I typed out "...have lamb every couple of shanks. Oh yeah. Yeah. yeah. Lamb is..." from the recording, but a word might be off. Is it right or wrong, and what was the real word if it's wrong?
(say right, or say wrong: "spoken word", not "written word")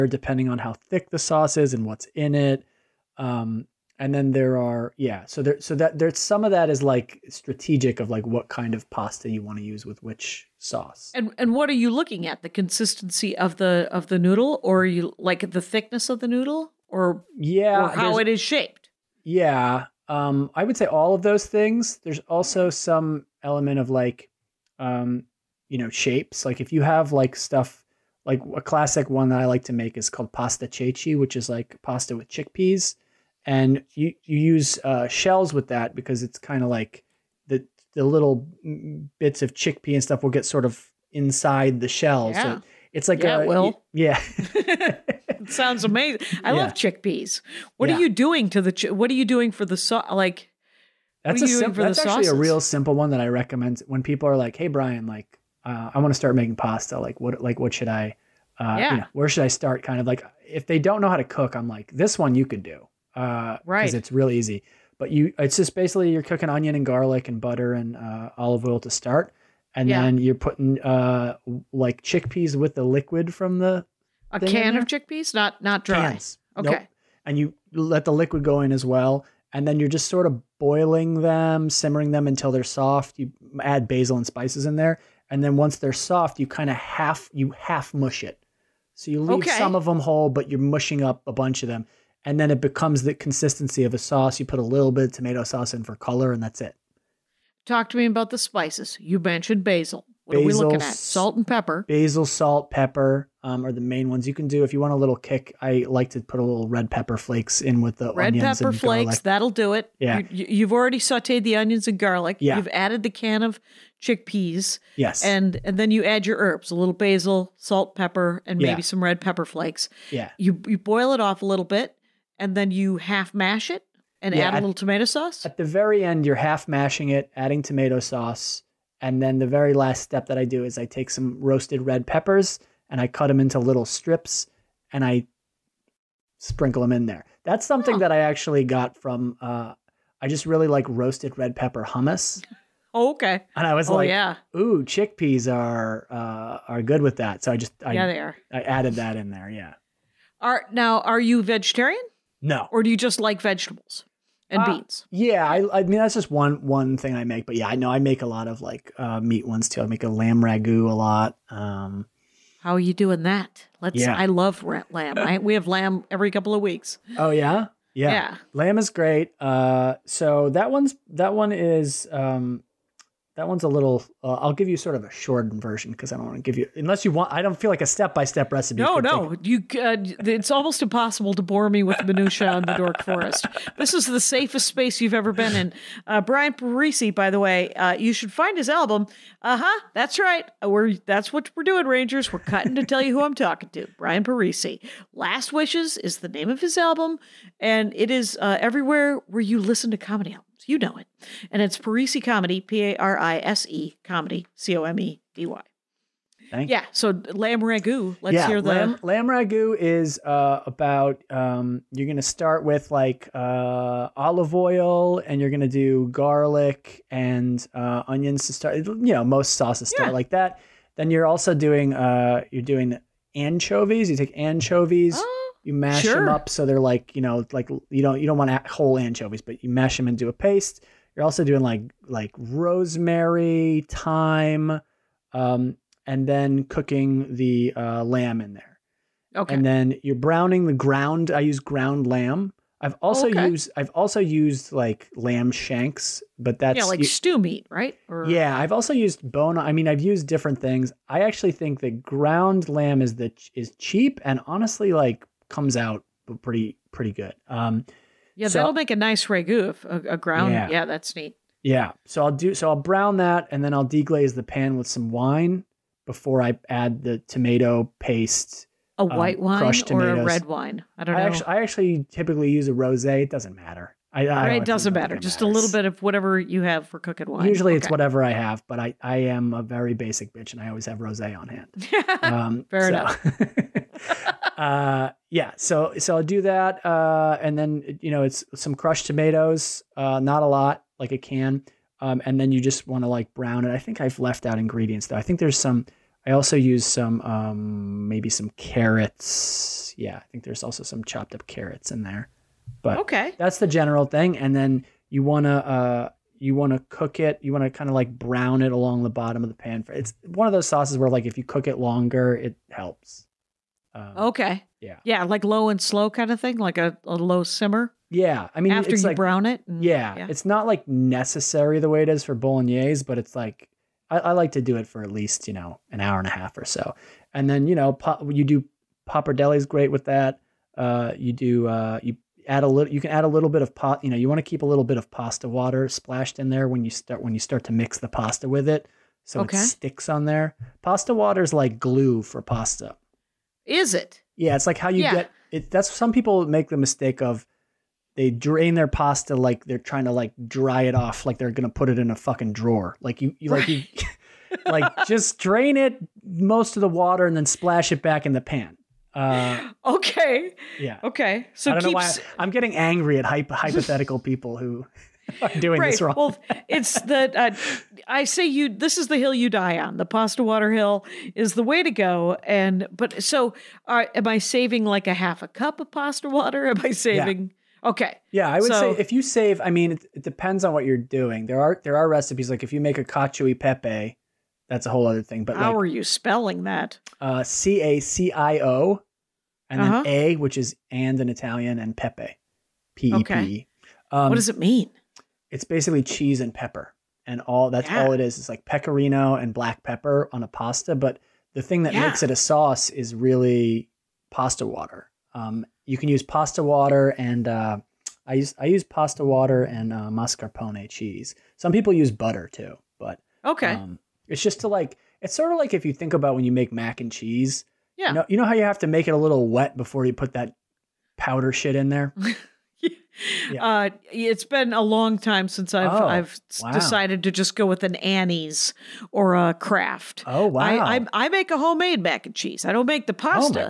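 wrong: "weeks", not "shanks".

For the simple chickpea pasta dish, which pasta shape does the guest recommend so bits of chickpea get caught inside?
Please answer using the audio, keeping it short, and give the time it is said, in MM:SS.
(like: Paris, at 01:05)
shells, at 00:35.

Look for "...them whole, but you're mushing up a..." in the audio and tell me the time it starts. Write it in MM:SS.
01:29.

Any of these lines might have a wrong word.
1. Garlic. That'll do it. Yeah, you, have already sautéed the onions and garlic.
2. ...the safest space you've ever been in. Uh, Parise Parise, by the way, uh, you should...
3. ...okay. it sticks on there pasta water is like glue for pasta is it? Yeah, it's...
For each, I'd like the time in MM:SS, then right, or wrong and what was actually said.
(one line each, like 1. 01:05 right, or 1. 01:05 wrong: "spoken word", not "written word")
1. 01:49 right
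2. 03:04 wrong: "Brian", not "Parise"
3. 05:39 right.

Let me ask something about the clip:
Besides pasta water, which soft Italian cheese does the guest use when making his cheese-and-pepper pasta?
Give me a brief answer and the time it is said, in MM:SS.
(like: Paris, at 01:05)
mascarpone, at 06:50.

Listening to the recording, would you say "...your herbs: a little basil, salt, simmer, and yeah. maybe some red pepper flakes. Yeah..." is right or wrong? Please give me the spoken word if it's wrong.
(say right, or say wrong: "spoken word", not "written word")
wrong: "pepper", not "simmer".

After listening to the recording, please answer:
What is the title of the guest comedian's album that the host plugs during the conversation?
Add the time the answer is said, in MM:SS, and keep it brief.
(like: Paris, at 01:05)
Last Wishes, at 03:15.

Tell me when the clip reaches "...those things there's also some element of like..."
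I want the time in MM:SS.
00:21.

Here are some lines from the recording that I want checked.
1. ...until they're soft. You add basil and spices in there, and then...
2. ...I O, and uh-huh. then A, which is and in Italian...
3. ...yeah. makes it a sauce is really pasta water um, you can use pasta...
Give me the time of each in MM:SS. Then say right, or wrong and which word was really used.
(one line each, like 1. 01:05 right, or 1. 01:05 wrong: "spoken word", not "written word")
1. 01:22 right
2. 06:28 right
3. 06:41 right.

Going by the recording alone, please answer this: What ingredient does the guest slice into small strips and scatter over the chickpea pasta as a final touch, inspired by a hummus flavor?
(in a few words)
roasted red peppers.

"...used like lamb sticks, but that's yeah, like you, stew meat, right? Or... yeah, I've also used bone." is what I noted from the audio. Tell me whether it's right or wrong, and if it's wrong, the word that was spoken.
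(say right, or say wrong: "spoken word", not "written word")
wrong: "shanks", not "sticks".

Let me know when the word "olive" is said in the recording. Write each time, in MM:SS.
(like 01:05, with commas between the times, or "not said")
01:08, 03:34.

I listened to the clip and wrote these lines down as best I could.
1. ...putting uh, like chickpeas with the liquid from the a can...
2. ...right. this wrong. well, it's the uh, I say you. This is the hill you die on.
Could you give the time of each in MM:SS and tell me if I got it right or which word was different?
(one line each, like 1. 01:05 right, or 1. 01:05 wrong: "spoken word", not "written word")
1. 01:10 right
2. 06:05 right.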